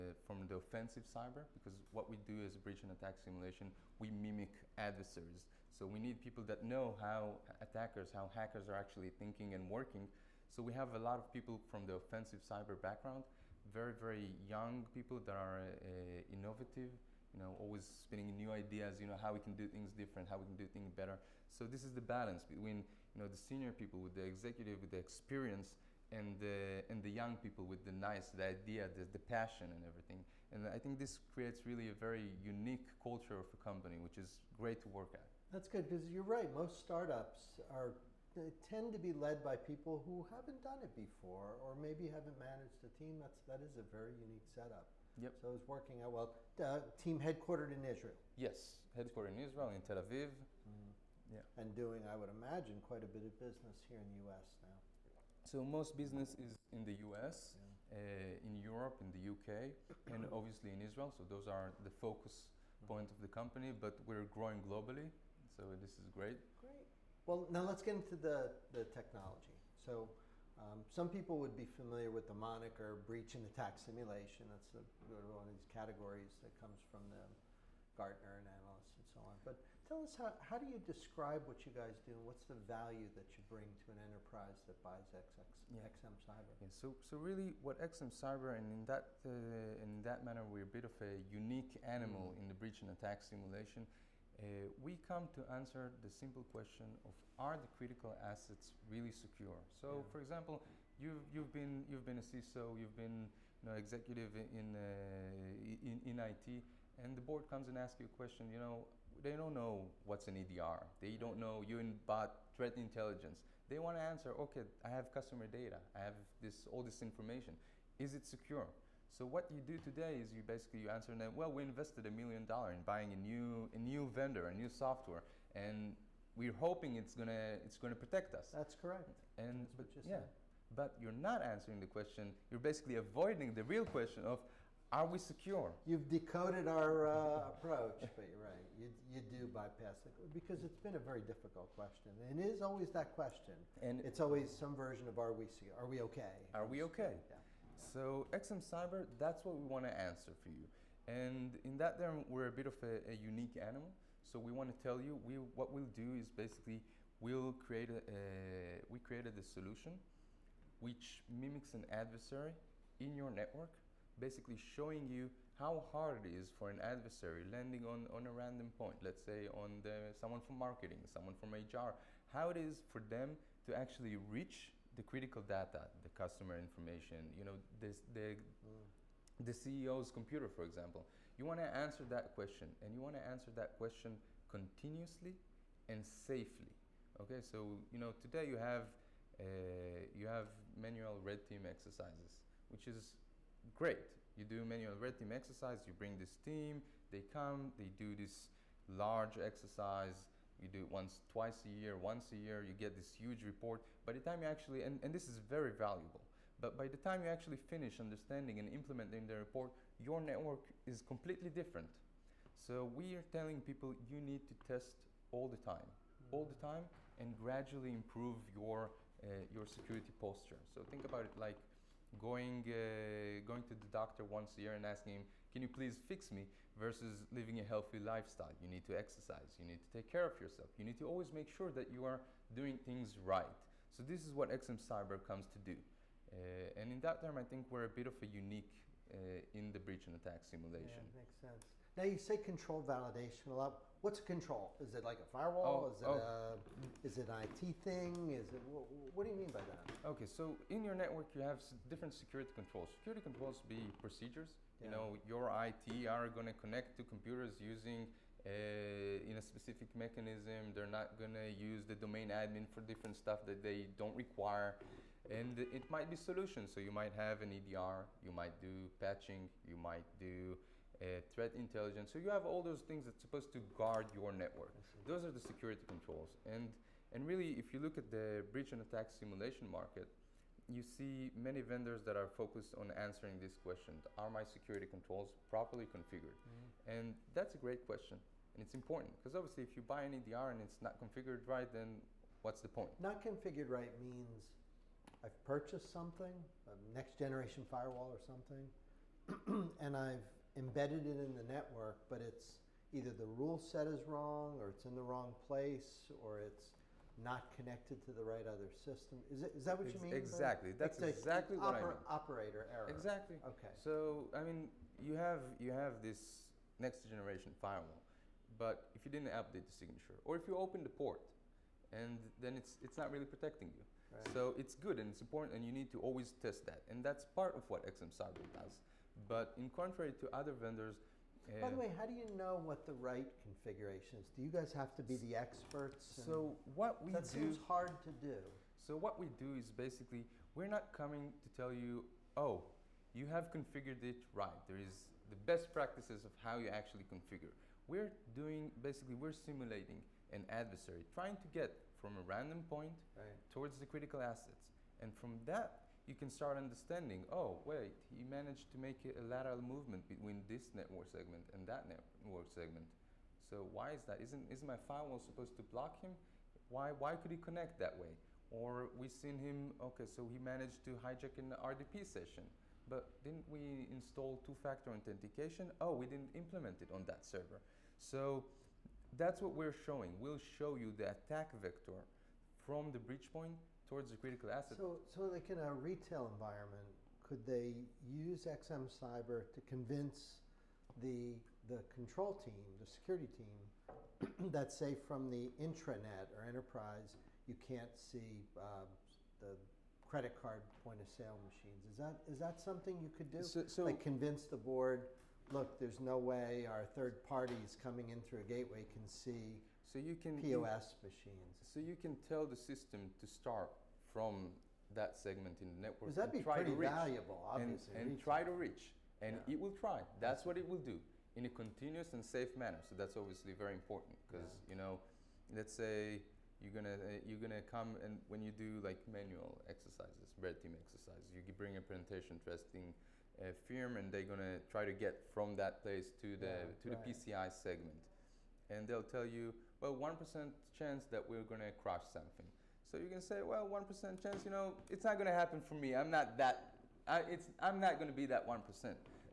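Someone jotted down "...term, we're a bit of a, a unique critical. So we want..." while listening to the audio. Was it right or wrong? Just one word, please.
wrong.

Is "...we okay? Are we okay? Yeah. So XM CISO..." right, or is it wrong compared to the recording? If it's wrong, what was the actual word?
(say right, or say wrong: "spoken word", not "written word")
wrong: "Cyber", not "CISO".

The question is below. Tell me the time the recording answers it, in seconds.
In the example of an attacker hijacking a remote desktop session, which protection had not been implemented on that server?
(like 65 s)
374 s.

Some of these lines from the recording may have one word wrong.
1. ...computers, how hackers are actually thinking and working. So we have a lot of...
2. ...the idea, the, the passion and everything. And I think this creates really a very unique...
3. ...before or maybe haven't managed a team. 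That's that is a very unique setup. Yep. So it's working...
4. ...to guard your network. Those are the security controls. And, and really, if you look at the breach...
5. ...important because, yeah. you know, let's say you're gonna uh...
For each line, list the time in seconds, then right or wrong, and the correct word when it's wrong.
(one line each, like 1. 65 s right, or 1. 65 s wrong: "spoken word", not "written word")
1. 7 s wrong: "attackers", not "computers"
2. 28 s right
3. 40 s right
4. 273 s right
5. 423 s right.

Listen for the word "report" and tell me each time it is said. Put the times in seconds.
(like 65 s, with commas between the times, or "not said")
203 s, 209 s.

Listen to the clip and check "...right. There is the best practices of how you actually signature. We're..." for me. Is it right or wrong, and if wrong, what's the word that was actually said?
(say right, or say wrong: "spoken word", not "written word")
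wrong: "configure", not "signature".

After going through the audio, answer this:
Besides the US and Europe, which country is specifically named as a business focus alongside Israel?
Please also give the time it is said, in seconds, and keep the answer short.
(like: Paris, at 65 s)
the U.K., at 59 s.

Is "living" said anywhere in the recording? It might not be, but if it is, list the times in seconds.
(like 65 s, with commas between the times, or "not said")
227 s.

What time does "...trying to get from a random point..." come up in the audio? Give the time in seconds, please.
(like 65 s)
351 s.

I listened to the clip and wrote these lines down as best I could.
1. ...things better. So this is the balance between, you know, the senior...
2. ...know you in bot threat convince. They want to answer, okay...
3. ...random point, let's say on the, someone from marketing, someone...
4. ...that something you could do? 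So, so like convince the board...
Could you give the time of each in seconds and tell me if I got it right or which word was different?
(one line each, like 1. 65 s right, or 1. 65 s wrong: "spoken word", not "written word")
1. 20 s right
2. 111 s wrong: "intelligence", not "convince"
3. 168 s right
4. 402 s right.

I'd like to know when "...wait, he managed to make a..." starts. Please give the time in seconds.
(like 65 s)
357 s.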